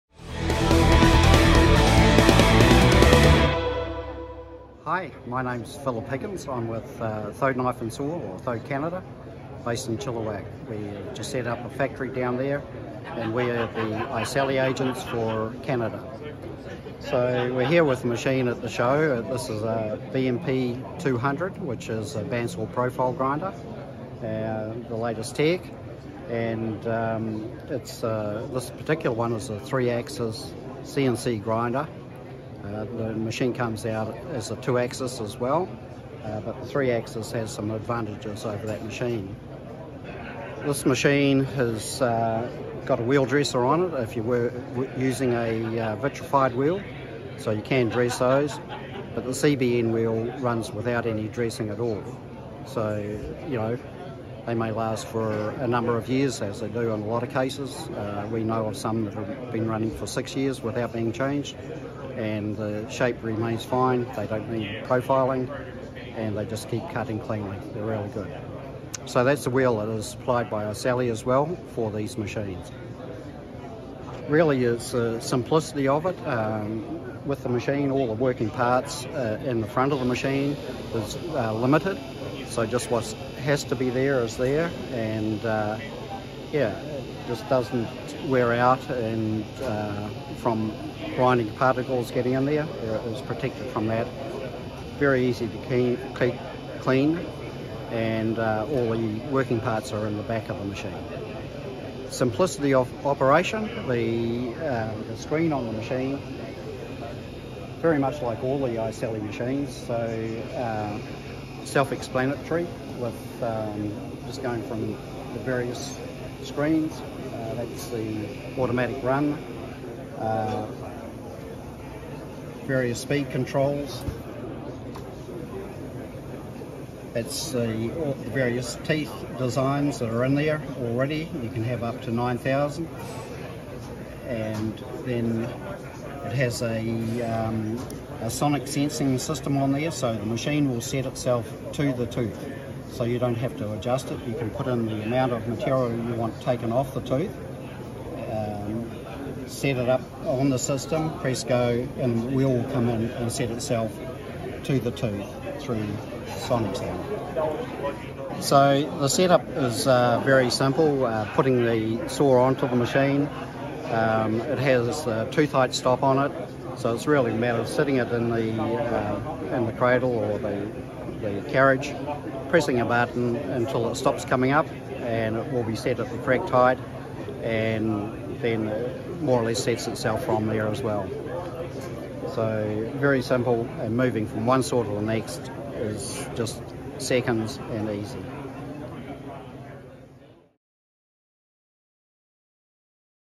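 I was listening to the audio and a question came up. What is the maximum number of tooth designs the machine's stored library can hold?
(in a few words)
9,000.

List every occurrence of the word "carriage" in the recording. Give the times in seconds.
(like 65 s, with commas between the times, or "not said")
171 s.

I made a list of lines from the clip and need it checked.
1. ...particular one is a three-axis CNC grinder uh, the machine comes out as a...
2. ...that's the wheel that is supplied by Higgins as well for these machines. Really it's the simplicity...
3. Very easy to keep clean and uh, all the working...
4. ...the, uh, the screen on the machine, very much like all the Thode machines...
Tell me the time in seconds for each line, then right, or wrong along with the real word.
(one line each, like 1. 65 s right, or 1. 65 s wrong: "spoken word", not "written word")
1. 28 s right
2. 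69 s wrong: "Iseli", not "Higgins"
3. 94 s right
4. 103 s wrong: "Iseli", not "Thode".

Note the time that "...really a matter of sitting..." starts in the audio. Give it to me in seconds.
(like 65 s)
167 s.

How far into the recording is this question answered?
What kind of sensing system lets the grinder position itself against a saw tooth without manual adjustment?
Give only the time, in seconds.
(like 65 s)
138 s.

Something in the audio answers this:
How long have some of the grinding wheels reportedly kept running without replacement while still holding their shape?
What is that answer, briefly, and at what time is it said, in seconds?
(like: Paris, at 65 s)
6 years, at 60 s.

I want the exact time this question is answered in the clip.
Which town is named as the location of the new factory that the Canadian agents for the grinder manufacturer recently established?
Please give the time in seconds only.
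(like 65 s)
9 s.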